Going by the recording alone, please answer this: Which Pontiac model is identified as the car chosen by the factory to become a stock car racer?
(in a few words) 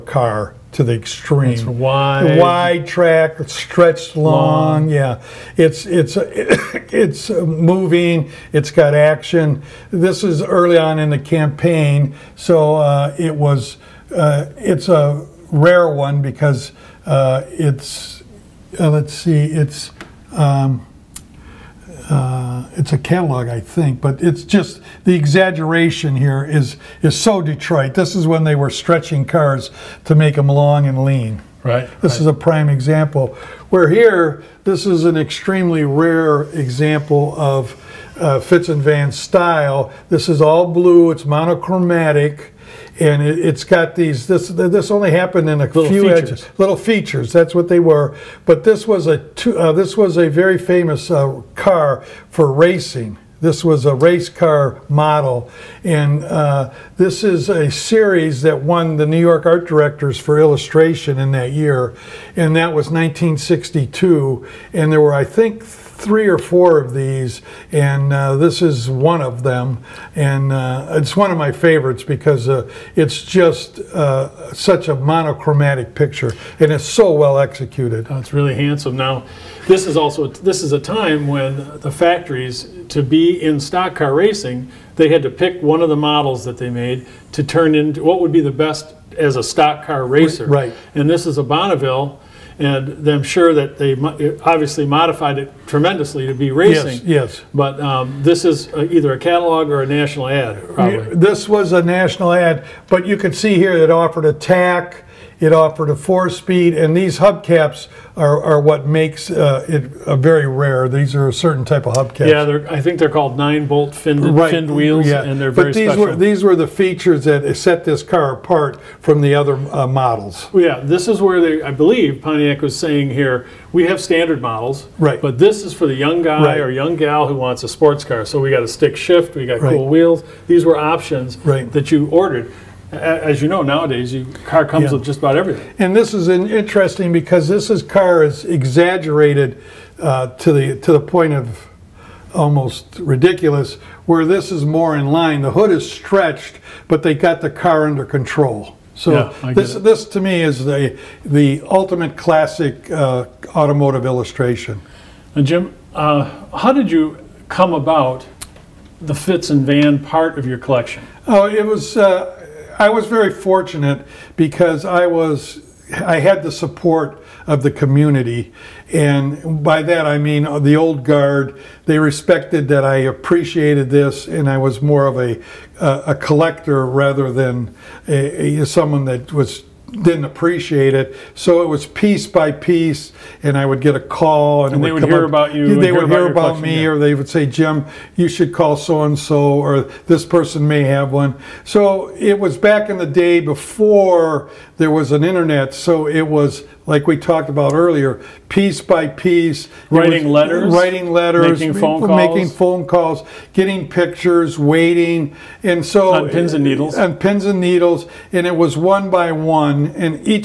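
Bonneville.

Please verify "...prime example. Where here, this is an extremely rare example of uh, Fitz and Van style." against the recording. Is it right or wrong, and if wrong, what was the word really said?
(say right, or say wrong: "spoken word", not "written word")
right.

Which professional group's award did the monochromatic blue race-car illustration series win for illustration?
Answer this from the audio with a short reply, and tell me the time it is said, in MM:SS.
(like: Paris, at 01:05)
New York Art Directors, at 00:59.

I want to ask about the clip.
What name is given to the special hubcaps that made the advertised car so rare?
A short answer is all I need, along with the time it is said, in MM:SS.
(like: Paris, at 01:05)
nine-bolt finned, at 01:53.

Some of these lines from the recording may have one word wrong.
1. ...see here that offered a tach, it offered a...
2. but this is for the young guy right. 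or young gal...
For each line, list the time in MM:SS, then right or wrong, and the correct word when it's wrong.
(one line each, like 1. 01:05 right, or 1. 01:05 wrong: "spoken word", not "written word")
1. 01:43 right
2. 02:05 right.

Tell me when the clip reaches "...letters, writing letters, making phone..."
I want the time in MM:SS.
03:20.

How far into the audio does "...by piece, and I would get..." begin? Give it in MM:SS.
03:02.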